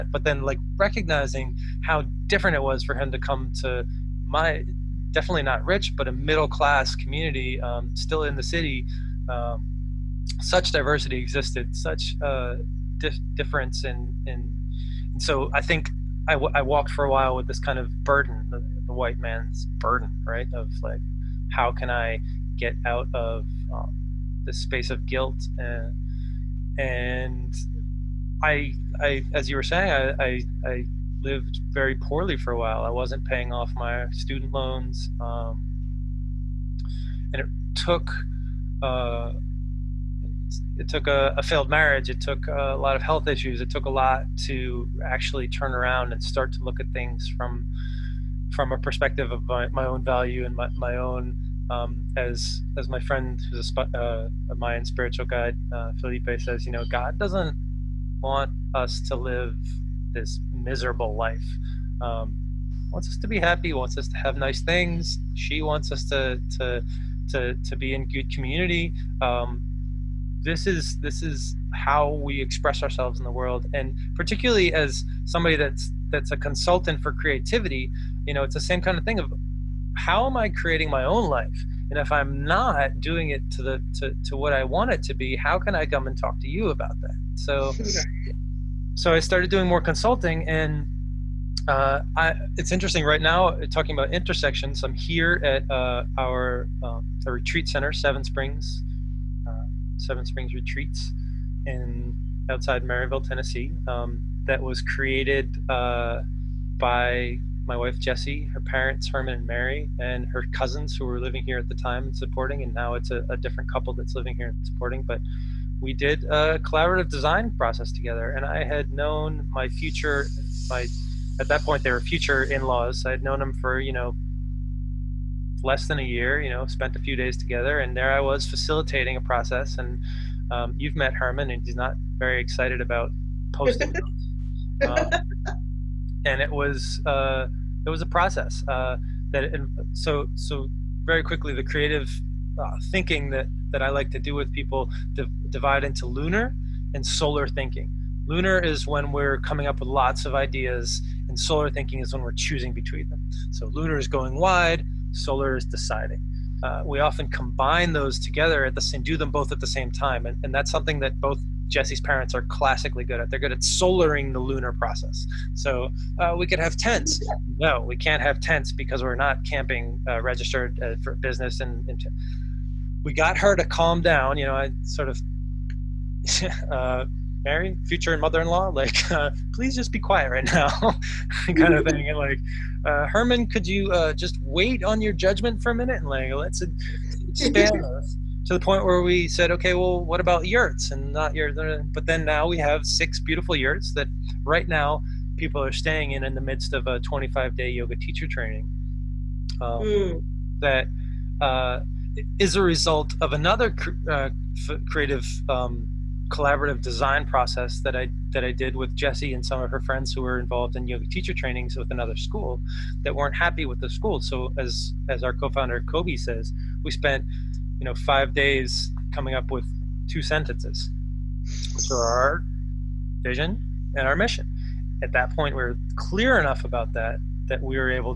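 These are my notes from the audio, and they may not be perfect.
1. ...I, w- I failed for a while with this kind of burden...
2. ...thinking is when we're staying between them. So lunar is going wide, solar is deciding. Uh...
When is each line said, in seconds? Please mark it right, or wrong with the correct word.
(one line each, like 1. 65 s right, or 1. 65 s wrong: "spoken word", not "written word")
1. 16 s wrong: "walked", not "failed"
2. 151 s wrong: "choosing", not "staying".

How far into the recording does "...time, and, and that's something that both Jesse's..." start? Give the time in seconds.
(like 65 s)
159 s.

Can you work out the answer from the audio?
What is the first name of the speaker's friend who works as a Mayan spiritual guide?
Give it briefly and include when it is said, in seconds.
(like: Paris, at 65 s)
Felipe, at 55 s.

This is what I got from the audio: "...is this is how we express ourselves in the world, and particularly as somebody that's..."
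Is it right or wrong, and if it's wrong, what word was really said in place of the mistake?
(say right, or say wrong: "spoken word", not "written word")
right.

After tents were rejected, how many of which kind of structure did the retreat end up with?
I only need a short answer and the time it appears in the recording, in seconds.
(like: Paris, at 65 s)
6 yurts, at 192 s.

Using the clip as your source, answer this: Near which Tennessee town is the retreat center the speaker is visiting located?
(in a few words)
Maryville.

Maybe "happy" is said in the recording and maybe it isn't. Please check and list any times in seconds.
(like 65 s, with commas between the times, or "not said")
63 s, 213 s.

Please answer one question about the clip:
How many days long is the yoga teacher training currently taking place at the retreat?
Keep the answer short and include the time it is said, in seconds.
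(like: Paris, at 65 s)
25, at 196 s.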